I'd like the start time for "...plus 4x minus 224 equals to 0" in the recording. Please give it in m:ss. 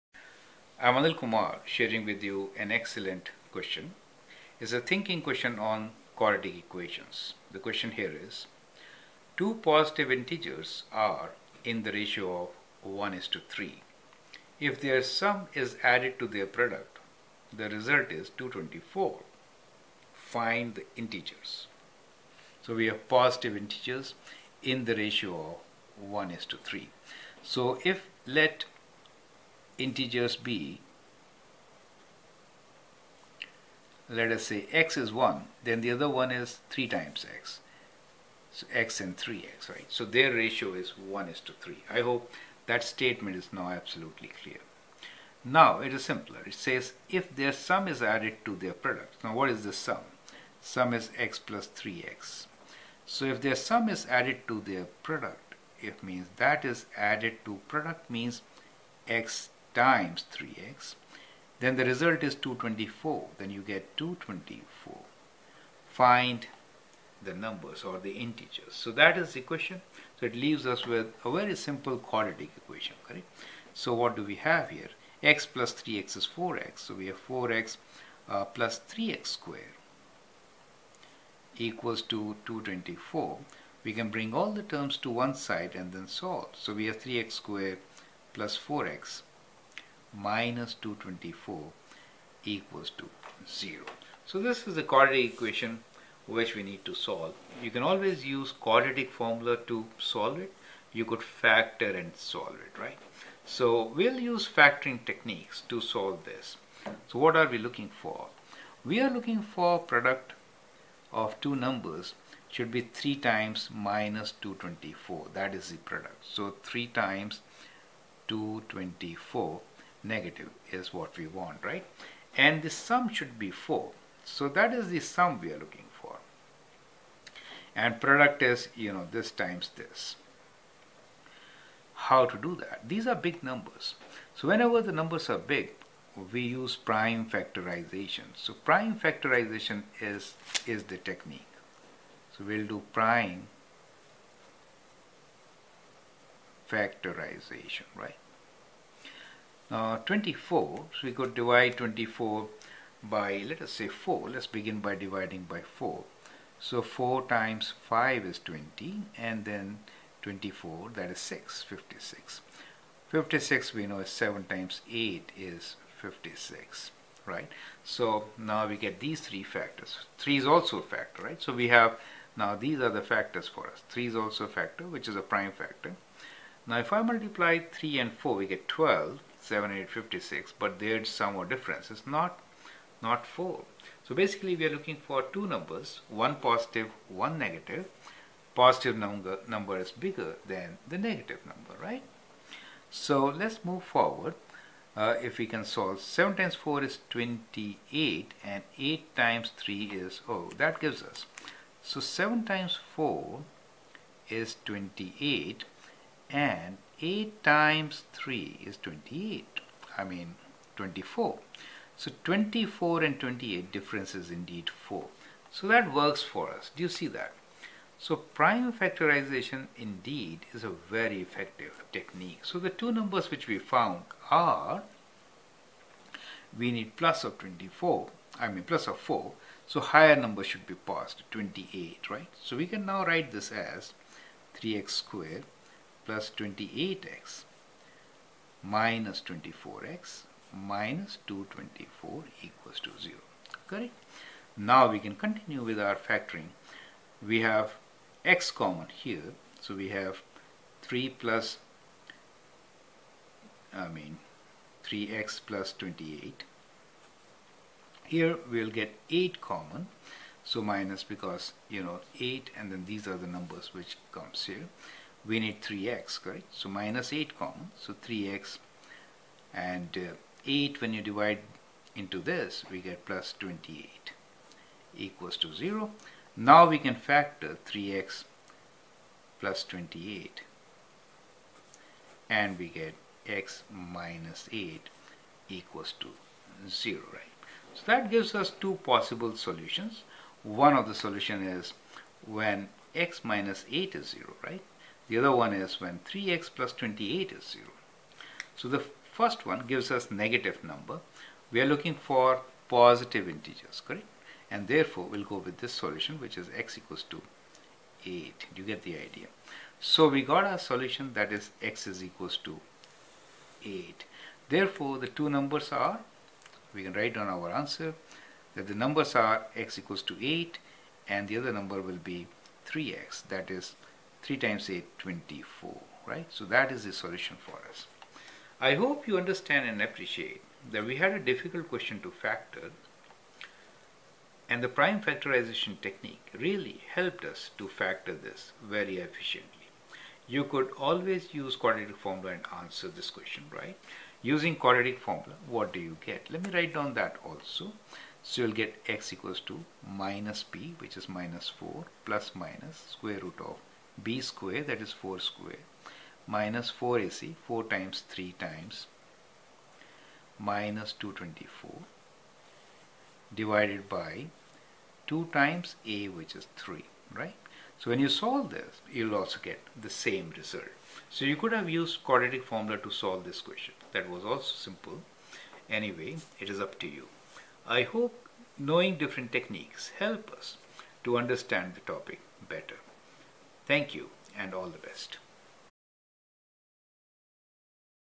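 1:28.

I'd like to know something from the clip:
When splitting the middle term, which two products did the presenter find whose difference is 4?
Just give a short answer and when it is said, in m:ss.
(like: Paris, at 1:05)
28 and 24, at 3:32.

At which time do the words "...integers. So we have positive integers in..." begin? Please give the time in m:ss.
0:20.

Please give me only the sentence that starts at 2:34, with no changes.
Let's begin by dividing by 4.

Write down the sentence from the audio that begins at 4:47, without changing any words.
So that gives us two possible solutions.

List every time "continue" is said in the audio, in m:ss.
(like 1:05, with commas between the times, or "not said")
4:05.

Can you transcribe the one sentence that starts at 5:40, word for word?
You could always use quadratic formula and answer this question, right?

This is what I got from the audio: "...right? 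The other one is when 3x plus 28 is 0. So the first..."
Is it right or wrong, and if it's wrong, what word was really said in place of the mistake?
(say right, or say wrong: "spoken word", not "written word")
right.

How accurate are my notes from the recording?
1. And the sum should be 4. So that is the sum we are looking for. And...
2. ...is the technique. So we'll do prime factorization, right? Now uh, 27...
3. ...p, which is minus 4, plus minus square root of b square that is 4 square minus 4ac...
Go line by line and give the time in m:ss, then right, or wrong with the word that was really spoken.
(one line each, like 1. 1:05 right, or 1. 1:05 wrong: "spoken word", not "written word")
1. 2:02 right
2. 2:20 wrong: "24", not "27"
3. 5:50 right.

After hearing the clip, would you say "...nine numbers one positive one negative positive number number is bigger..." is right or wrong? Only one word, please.
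wrong.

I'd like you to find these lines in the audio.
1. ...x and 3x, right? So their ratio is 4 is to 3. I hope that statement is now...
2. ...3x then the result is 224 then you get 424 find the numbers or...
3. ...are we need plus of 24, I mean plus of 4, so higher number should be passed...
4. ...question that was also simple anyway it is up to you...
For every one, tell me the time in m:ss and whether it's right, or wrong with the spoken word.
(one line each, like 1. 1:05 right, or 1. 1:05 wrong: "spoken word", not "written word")
1. 0:38 wrong: "1", not "4"
2. 1:00 wrong: "224", not "424"
3. 3:44 right
4. 6:13 right.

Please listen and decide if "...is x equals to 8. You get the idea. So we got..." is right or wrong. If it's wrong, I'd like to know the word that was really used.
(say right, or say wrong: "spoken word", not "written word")
right.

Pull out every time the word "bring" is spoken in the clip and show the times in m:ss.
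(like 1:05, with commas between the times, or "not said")
1:24.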